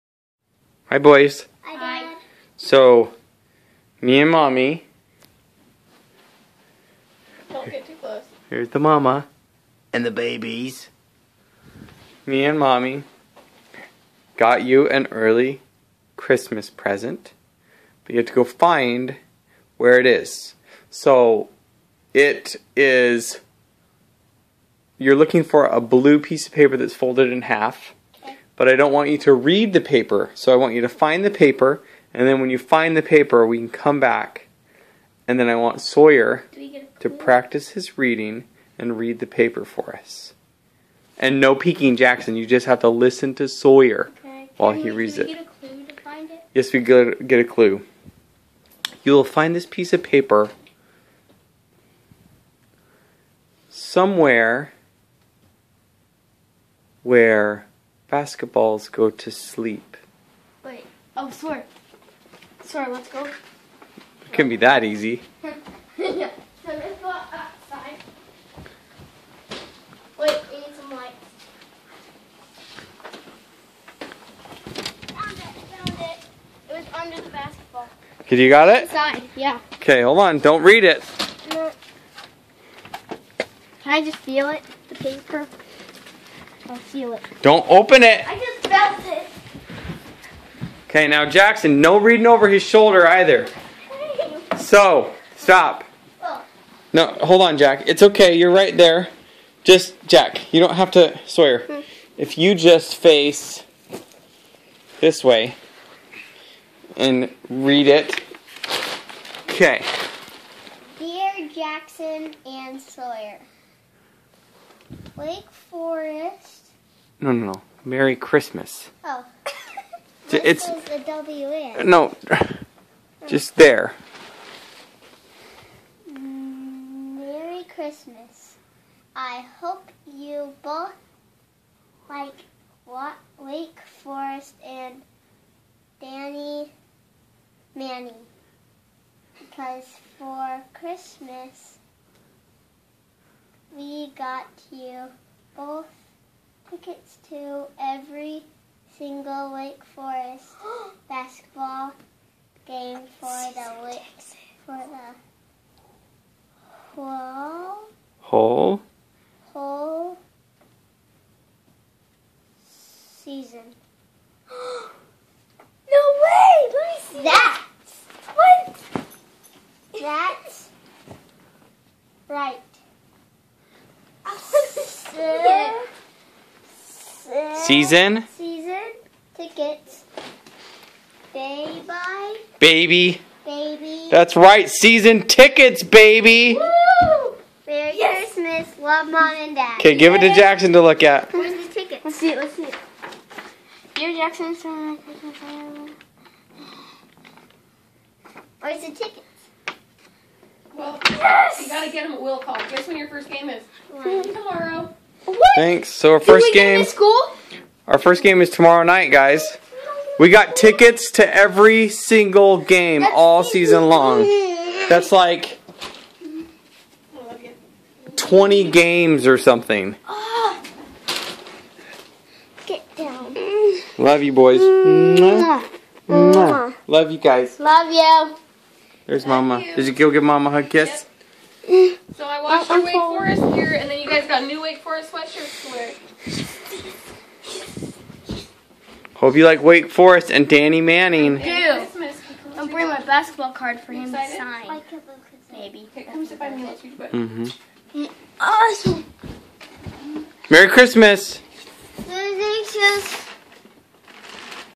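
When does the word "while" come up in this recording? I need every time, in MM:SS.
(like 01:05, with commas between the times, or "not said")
00:44.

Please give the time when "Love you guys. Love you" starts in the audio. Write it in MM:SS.
03:46.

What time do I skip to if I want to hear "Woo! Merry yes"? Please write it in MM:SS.
03:06.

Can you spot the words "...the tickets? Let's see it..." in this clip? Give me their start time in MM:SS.
03:11.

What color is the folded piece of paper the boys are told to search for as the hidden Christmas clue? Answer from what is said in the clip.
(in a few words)
Blue.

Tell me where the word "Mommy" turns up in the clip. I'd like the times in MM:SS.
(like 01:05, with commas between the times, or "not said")
00:04, 00:12.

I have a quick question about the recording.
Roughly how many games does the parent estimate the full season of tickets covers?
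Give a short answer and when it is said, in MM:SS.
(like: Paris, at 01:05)
20, at 03:38.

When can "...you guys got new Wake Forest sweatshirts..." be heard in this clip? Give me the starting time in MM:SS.
03:54.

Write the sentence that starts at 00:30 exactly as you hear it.
So I want you to find the paper, and then when you find the paper, we can come back.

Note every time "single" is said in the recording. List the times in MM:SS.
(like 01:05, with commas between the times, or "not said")
02:28, 03:31.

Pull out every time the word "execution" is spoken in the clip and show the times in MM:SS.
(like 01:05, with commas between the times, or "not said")
not said.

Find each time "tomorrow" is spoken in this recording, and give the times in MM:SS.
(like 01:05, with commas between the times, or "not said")
03:23, 03:28.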